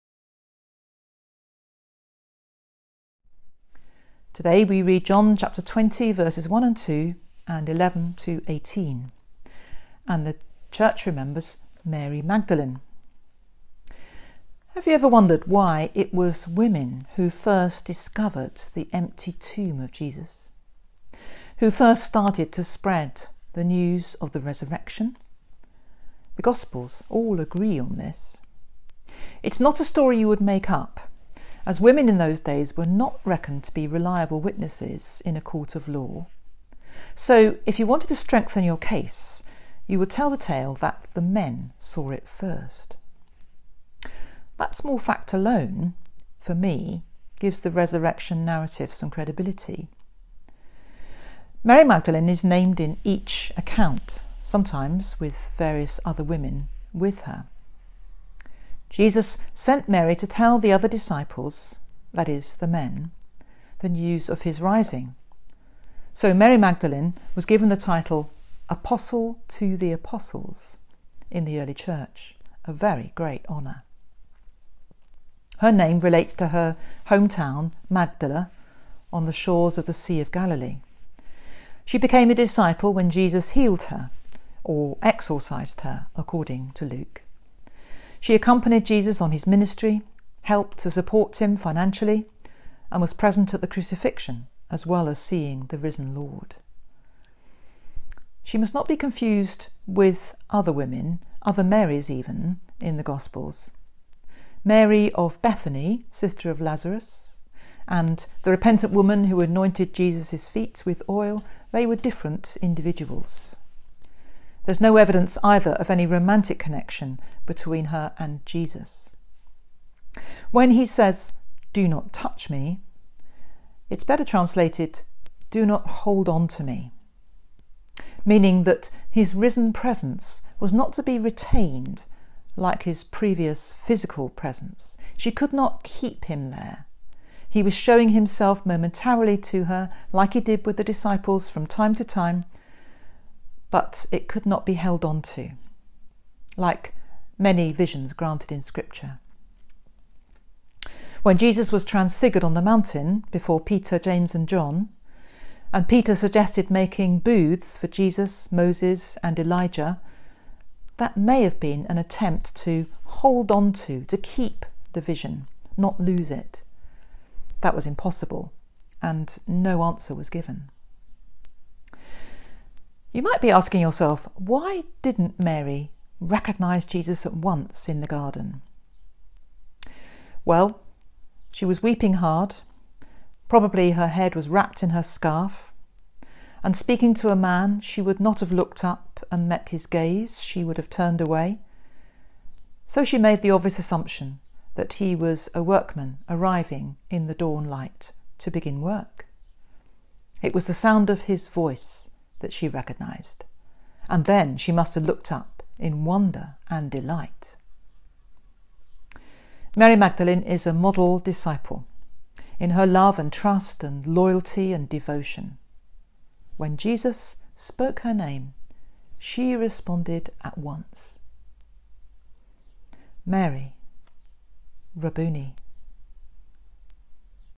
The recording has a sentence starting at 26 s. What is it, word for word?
The Gospels all agree on this.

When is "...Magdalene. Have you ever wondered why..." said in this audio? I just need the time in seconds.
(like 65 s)
12 s.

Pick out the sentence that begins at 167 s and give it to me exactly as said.
That was impossible, and no answer was given.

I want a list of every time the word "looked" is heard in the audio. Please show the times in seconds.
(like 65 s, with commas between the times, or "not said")
188 s, 205 s.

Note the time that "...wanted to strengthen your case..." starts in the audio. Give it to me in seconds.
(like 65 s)
37 s.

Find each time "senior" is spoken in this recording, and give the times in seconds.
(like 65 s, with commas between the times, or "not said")
not said.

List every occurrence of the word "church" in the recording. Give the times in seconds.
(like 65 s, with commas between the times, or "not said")
10 s, 71 s.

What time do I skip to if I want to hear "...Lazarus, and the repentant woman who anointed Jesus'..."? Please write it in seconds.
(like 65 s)
106 s.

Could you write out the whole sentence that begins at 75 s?
Her name relates to her hometown, Magdala, on the shores of the Sea of Galilee.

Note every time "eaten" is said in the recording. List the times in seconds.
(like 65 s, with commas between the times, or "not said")
not said.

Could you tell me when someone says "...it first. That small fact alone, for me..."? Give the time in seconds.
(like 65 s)
42 s.